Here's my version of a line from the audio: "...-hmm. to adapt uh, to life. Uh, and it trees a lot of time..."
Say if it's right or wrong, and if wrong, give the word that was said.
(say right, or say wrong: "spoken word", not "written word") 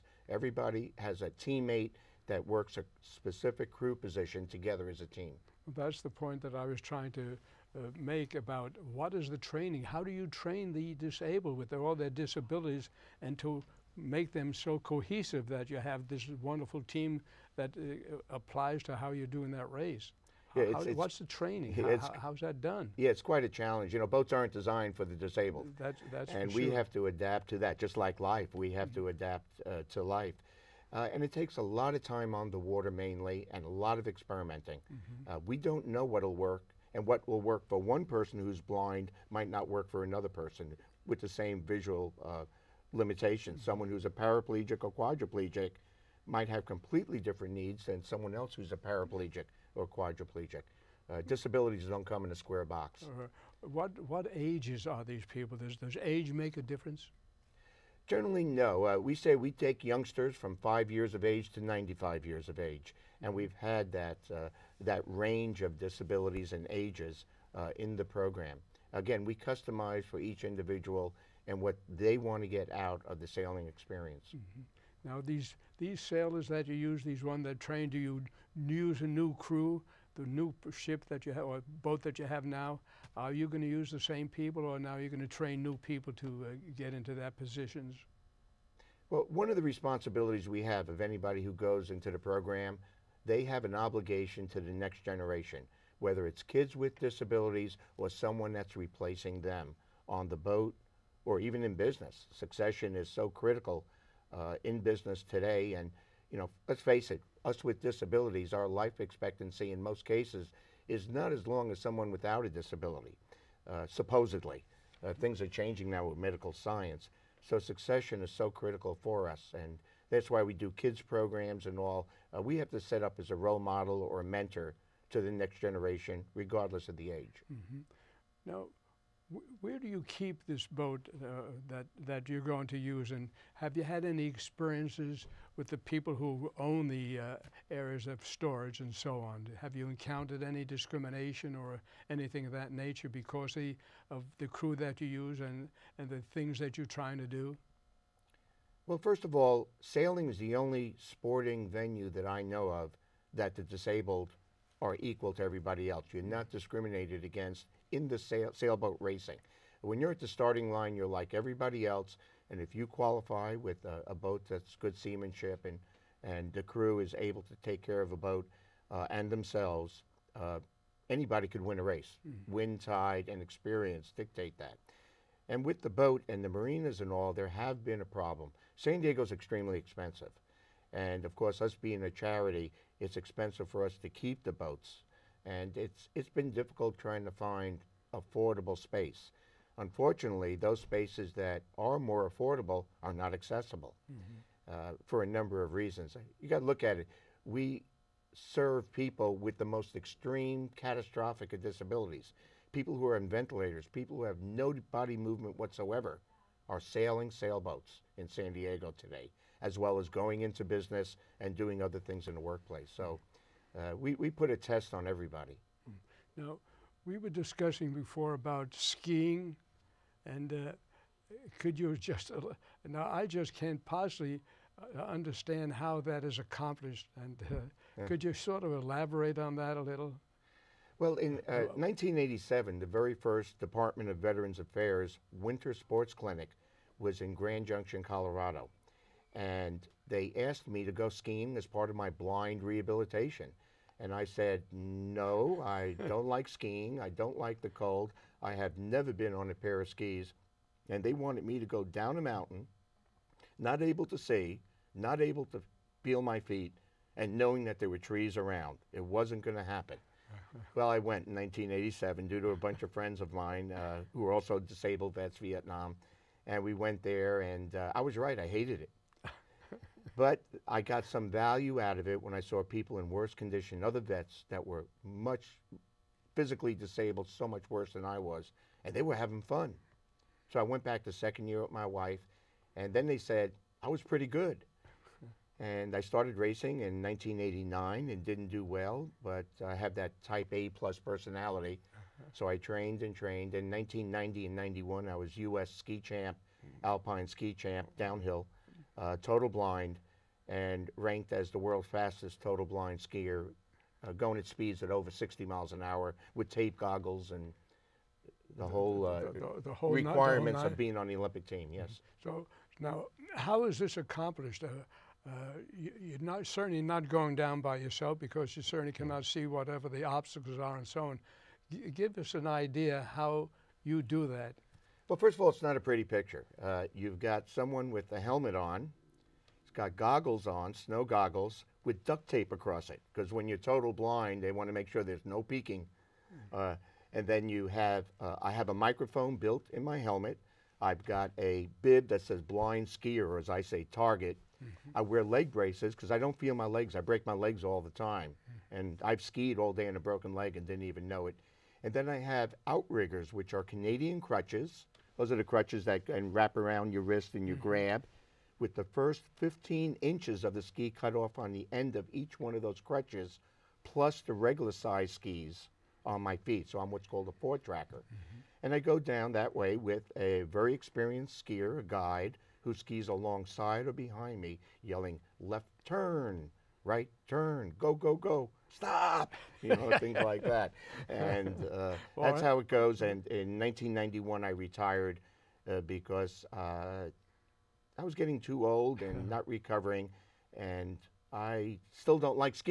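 wrong: "takes", not "trees".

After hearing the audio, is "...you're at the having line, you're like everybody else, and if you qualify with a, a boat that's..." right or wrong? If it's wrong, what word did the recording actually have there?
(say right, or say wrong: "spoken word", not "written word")
wrong: "starting", not "having".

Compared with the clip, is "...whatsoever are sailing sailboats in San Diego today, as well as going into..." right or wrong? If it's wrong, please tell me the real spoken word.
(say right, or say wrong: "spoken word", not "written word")
right.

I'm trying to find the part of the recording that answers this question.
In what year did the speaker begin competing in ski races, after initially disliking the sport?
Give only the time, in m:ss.
4:47.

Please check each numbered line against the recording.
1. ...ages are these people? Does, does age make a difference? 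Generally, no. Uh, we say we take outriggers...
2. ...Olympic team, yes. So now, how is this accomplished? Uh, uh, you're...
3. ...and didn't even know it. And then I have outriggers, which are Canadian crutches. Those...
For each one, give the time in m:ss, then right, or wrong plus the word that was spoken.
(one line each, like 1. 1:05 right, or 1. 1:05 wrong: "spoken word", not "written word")
1. 0:54 wrong: "youngsters", not "outriggers"
2. 5:11 right
3. 5:50 right.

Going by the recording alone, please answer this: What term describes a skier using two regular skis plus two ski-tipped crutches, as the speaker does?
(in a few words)
four tracker.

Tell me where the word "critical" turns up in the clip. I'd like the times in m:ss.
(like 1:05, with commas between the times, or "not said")
1:43, 1:58.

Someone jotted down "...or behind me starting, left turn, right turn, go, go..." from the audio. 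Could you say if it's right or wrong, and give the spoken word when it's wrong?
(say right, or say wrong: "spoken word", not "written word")
wrong: "yelling", not "starting".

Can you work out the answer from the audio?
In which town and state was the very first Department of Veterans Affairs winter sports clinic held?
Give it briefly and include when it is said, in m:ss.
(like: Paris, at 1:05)
Grand Junction, Colorado, at 3:57.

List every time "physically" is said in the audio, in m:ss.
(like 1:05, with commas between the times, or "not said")
4:36.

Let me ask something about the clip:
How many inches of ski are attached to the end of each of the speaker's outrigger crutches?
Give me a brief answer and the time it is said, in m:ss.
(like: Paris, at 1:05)
15, at 5:59.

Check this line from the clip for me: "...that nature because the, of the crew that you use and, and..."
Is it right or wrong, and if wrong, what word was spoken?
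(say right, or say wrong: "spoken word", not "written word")
right.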